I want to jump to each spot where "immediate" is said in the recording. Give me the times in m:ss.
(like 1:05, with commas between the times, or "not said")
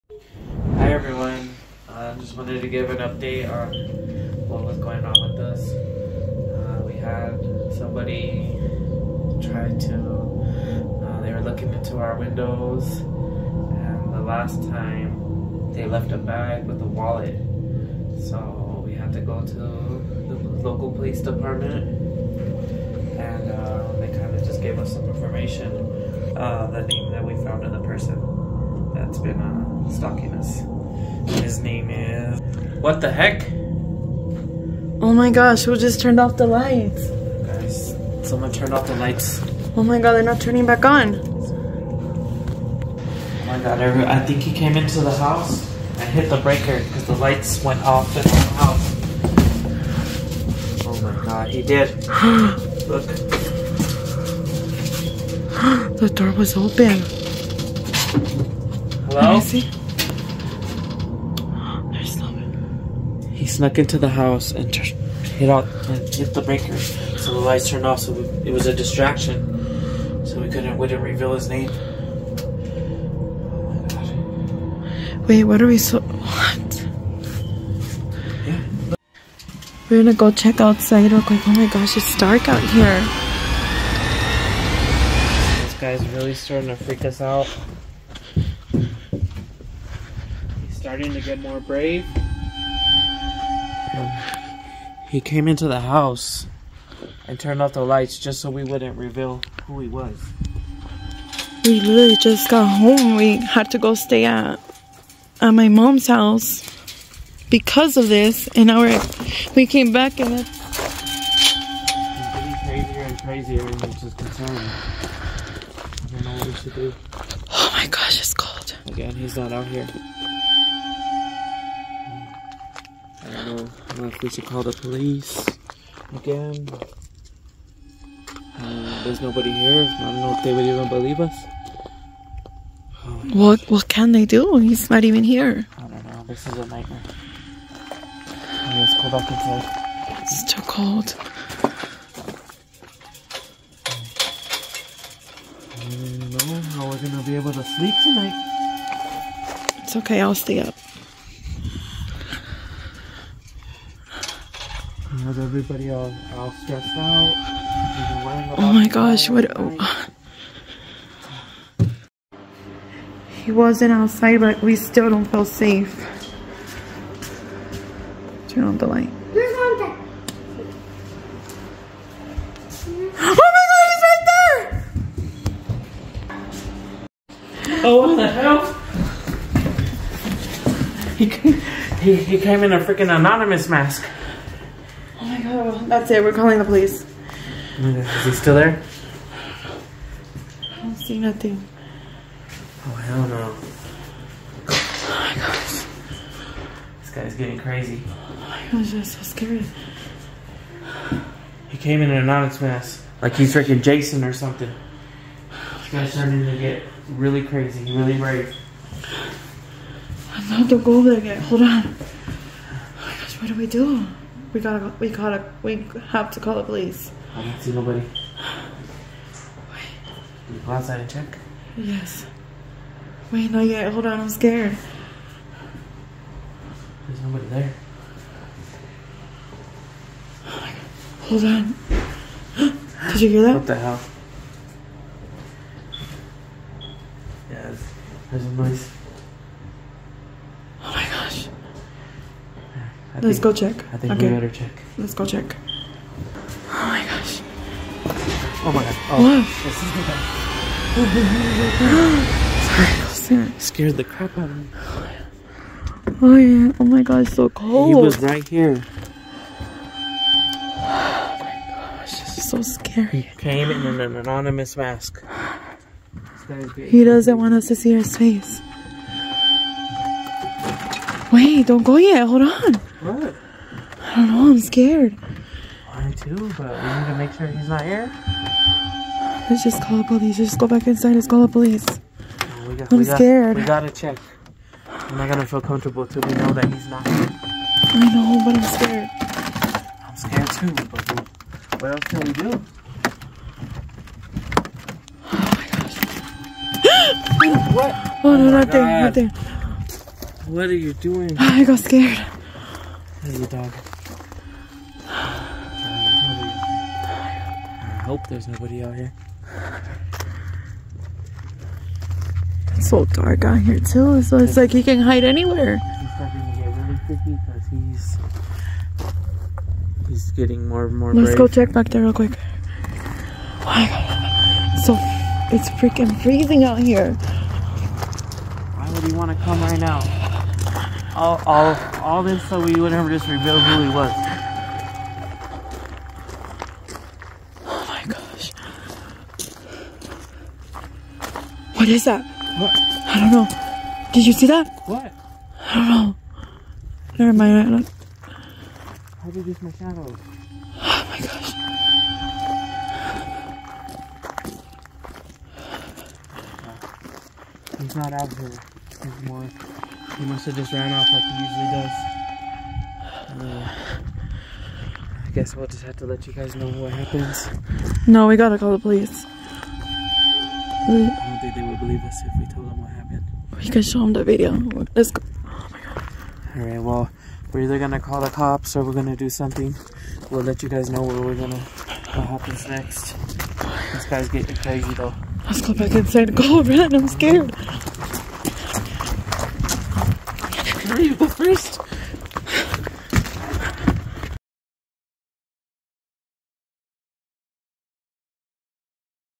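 not said.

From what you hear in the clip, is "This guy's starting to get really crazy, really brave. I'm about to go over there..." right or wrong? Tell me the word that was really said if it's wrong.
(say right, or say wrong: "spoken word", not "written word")
right.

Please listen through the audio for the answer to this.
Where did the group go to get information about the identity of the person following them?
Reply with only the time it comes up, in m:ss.
0:20.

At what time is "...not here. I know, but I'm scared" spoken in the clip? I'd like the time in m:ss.
4:46.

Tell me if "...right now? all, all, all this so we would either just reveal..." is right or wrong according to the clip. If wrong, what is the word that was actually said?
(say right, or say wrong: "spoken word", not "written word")
wrong: "never", not "either".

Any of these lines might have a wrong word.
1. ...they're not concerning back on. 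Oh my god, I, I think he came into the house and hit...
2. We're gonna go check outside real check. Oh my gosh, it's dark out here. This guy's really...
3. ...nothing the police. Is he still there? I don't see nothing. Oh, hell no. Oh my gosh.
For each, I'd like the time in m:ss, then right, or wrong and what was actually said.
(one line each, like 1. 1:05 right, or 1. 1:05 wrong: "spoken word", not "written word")
1. 0:40 wrong: "turning", not "concerning"
2. 1:19 wrong: "quick", not "check"
3. 3:06 wrong: "calling", not "nothing".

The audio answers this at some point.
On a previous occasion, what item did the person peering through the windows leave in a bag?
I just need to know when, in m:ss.
0:16.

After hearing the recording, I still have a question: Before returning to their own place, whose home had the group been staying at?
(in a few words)
my mom's house.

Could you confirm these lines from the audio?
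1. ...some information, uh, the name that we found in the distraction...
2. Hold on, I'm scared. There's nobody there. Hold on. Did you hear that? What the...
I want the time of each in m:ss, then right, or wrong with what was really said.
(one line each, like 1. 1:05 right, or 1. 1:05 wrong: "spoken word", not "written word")
1. 0:24 wrong: "person", not "distraction"
2. 3:43 right.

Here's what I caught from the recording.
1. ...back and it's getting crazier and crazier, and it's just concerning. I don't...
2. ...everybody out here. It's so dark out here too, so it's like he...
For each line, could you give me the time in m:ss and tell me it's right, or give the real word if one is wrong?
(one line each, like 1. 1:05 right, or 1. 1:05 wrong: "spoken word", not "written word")
1. 1:49 right
2. 5:08 wrong: "nobody", not "everybody".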